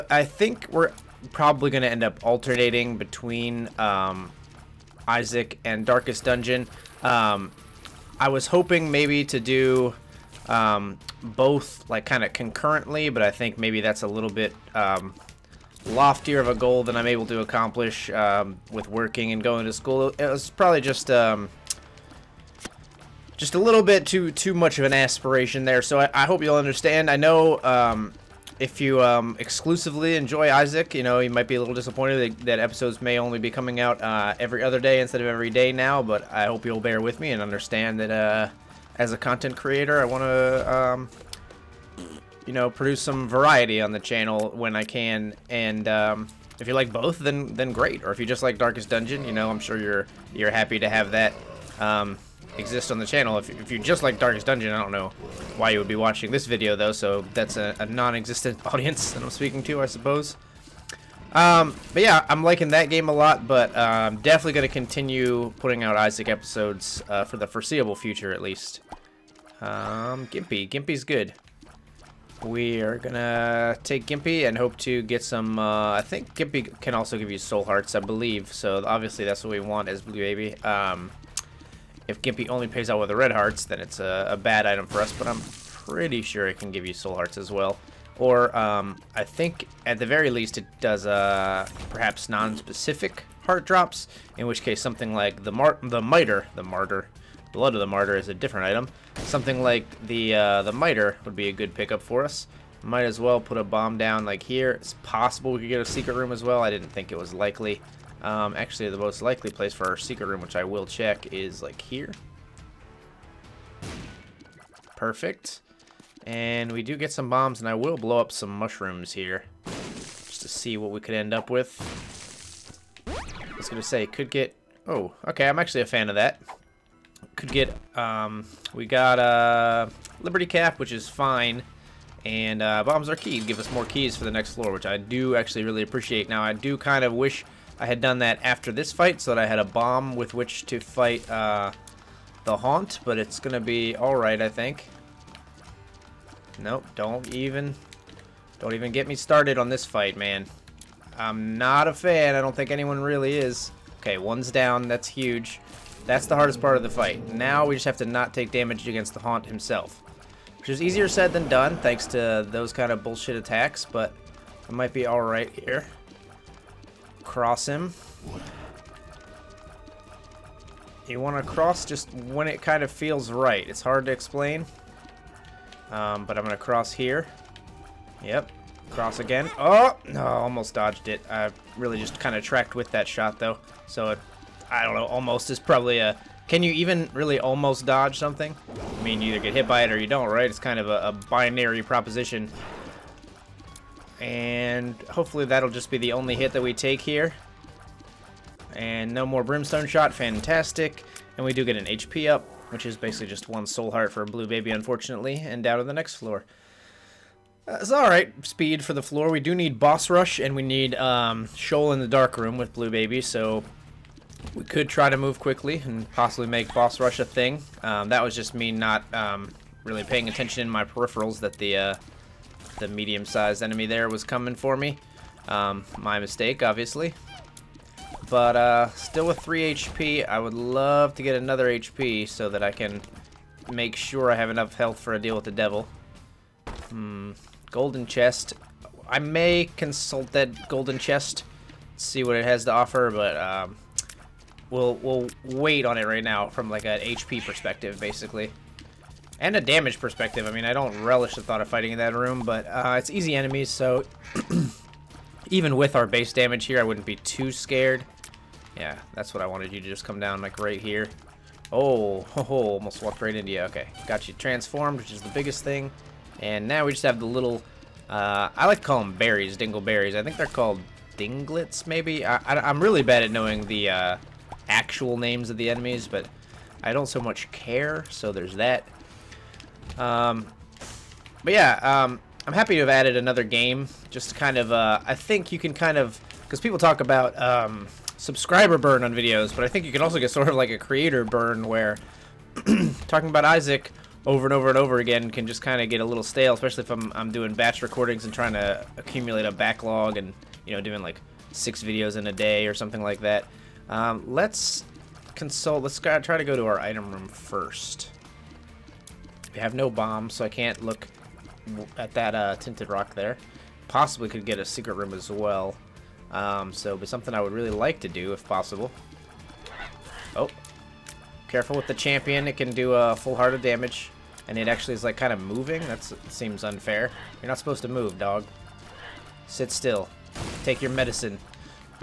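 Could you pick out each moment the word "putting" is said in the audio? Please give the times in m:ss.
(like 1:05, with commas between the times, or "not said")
1:05.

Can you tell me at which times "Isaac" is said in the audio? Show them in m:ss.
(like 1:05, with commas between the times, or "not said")
0:05, 0:30, 1:05, 4:53.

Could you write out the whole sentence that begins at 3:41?
Uh, the medium-sized enemy there was coming for me.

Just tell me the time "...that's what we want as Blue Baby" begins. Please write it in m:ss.
1:19.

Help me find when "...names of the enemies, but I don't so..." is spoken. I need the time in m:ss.
4:35.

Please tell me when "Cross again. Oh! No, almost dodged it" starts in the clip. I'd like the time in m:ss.
2:58.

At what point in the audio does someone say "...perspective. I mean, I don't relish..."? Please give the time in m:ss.
4:10.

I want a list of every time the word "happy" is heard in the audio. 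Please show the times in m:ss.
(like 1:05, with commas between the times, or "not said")
0:50, 4:42.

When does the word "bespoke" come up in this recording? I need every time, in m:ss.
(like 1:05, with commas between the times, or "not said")
not said.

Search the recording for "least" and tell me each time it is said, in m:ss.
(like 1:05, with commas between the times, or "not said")
1:08, 1:30.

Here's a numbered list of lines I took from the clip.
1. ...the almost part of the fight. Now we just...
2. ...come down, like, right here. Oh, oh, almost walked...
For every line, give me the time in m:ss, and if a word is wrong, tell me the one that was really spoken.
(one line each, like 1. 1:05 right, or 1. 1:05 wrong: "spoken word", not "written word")
1. 2:36 wrong: "hardest", not "almost"
2. 4:20 right.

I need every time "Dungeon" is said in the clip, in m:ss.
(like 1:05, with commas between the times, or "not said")
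0:06, 0:48, 0:54.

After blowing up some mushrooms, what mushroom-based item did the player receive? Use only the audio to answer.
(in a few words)
Liberty Cap.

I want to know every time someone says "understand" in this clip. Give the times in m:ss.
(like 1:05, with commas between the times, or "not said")
0:26, 0:37.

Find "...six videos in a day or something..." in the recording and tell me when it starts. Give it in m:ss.
5:01.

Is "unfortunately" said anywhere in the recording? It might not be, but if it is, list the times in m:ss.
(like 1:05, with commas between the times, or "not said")
3:24.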